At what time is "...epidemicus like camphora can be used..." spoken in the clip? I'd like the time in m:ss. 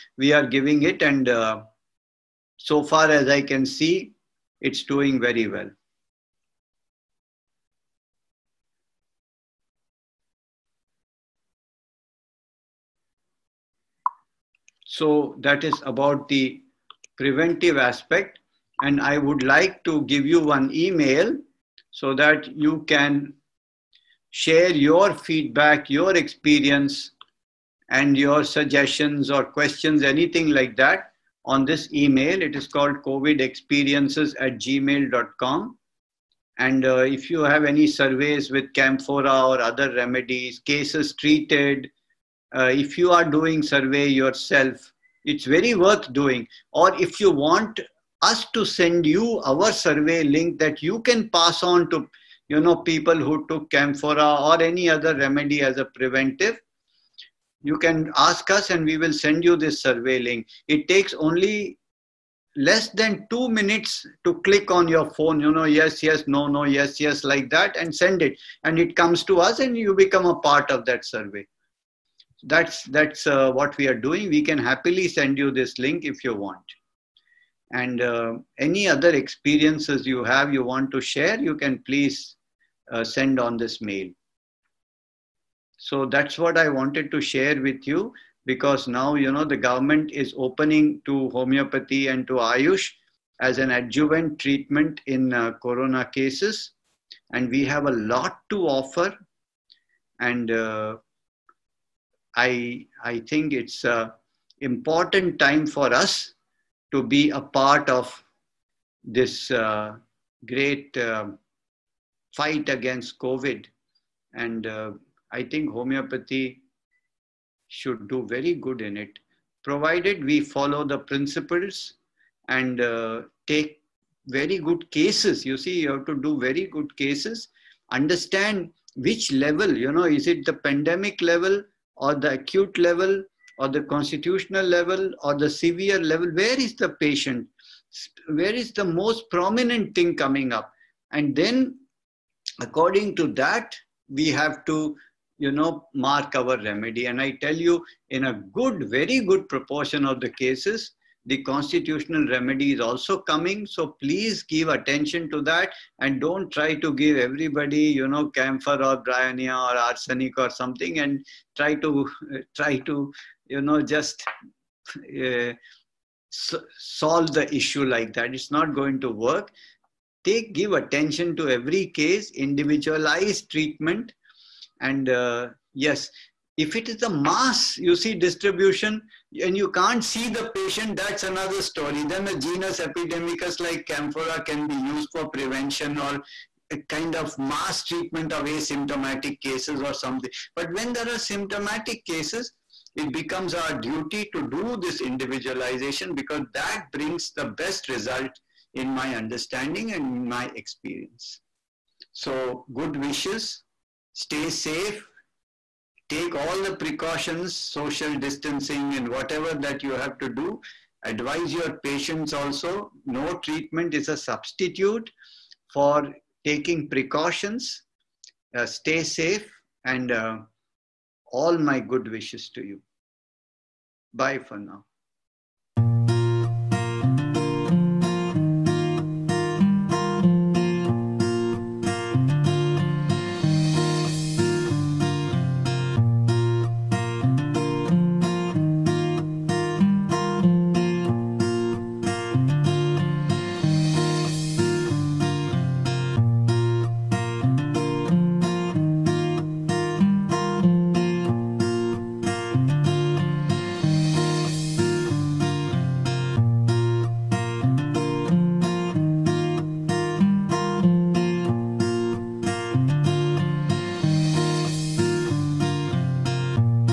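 3:02.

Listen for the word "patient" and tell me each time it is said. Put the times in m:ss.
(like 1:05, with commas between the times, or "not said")
2:16, 3:00, 3:31.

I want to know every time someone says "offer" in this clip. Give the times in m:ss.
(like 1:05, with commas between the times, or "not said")
1:38.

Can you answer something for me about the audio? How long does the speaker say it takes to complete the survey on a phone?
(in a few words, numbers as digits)
less than 2 minutes.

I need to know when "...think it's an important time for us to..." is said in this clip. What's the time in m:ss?
1:43.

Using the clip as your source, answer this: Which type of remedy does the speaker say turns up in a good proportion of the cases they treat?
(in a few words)
constitutional remedy.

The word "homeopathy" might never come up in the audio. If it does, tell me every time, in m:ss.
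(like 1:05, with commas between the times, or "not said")
1:31, 1:55.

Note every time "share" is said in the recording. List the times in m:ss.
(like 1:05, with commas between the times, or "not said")
0:24, 1:21, 1:27.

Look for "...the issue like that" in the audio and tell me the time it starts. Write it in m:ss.
2:47.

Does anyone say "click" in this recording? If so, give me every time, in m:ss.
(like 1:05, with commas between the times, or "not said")
1:04.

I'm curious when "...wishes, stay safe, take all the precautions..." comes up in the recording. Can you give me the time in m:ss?
3:22.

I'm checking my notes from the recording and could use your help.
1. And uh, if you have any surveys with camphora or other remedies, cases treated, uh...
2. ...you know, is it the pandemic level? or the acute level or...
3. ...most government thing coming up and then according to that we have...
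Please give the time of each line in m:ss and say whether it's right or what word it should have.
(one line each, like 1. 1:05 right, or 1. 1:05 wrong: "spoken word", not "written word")
1. 0:36 right
2. 2:09 right
3. 2:18 wrong: "prominent", not "government".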